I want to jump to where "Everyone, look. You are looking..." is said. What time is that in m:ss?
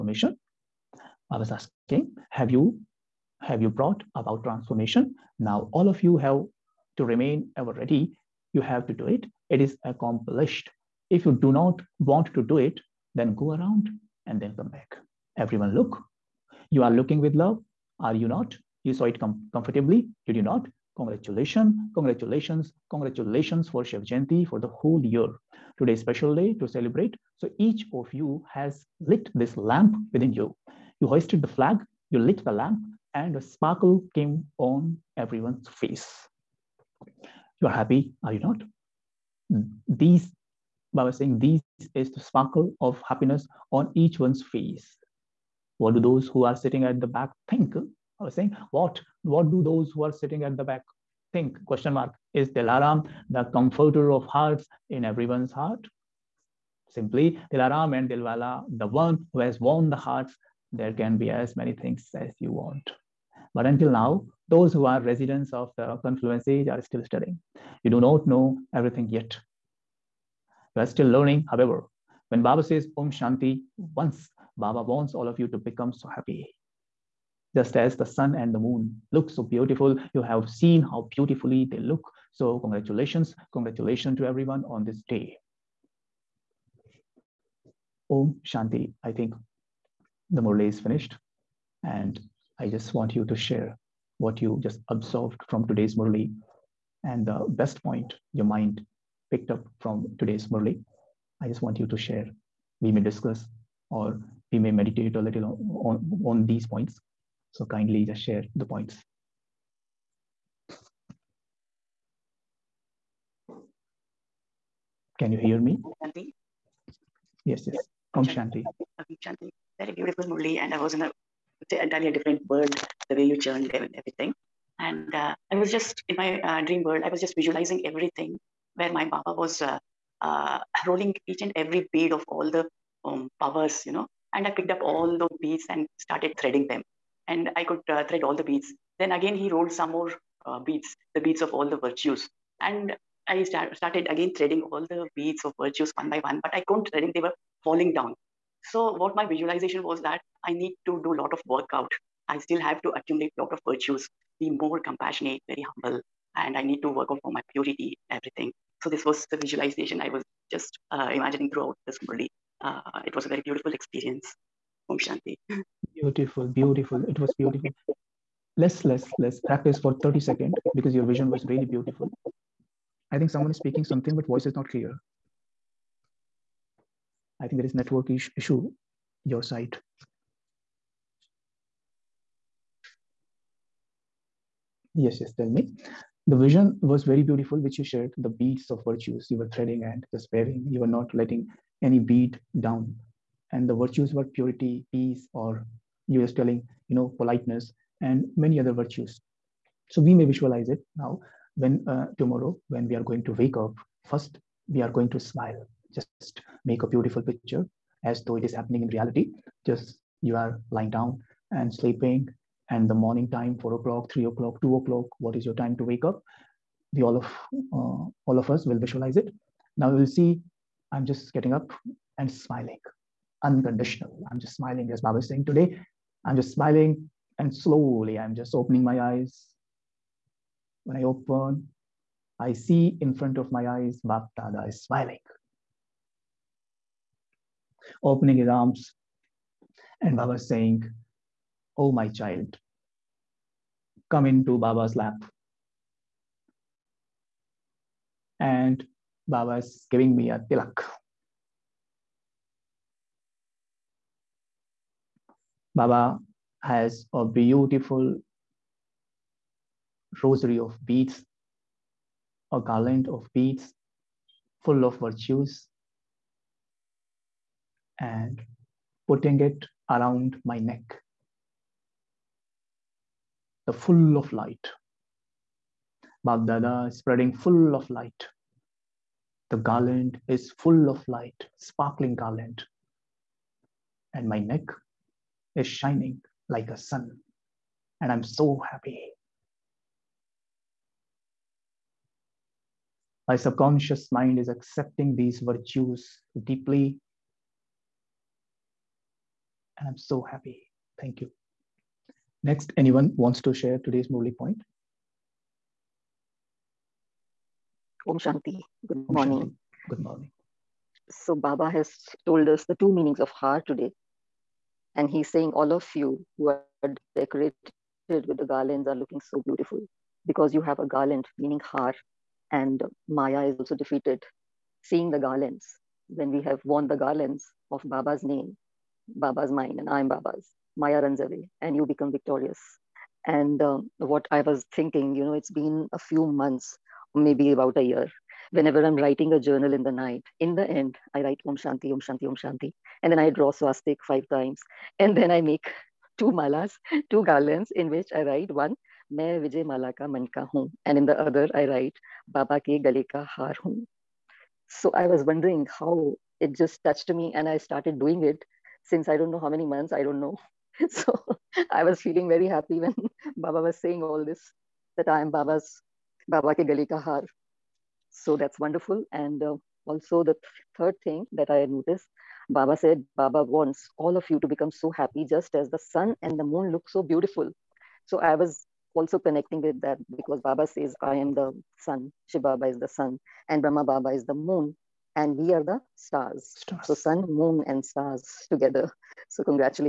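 0:15.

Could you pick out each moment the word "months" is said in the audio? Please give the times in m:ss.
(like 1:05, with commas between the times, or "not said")
5:36, 5:59.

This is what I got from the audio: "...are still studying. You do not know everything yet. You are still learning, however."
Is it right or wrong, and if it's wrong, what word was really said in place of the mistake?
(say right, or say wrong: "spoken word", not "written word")
right.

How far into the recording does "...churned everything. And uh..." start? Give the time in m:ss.
2:03.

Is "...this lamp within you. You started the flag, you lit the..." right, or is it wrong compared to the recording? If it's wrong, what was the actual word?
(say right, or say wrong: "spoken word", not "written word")
wrong: "hoisted", not "started".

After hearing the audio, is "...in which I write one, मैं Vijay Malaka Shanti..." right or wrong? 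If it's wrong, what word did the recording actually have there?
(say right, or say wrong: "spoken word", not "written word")
wrong: "Manka", not "Shanti".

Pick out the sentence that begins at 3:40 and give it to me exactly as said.
I'm just getting up and smiling unconditional.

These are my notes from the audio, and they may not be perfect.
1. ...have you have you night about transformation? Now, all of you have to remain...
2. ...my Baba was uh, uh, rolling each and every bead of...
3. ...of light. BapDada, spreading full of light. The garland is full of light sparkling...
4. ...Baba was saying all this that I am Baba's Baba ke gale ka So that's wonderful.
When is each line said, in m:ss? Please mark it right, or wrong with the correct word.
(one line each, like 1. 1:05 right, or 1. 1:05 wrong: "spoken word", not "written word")
1. 0:02 wrong: "brought", not "night"
2. 2:08 right
3. 4:34 right
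4. 6:03 right.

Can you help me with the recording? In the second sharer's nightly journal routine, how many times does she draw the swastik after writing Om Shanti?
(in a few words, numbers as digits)
5.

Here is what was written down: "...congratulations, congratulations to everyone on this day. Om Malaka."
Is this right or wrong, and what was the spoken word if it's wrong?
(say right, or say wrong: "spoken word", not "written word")
wrong: "Shanti", not "Malaka".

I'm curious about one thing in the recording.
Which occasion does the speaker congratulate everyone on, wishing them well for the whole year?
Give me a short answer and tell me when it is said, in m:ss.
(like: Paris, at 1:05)
Shiv Jayanti, at 0:23.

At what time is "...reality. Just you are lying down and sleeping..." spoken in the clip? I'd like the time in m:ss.
3:28.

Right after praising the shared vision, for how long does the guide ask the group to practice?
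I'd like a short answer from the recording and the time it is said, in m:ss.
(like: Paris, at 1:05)
30 seconds, at 2:50.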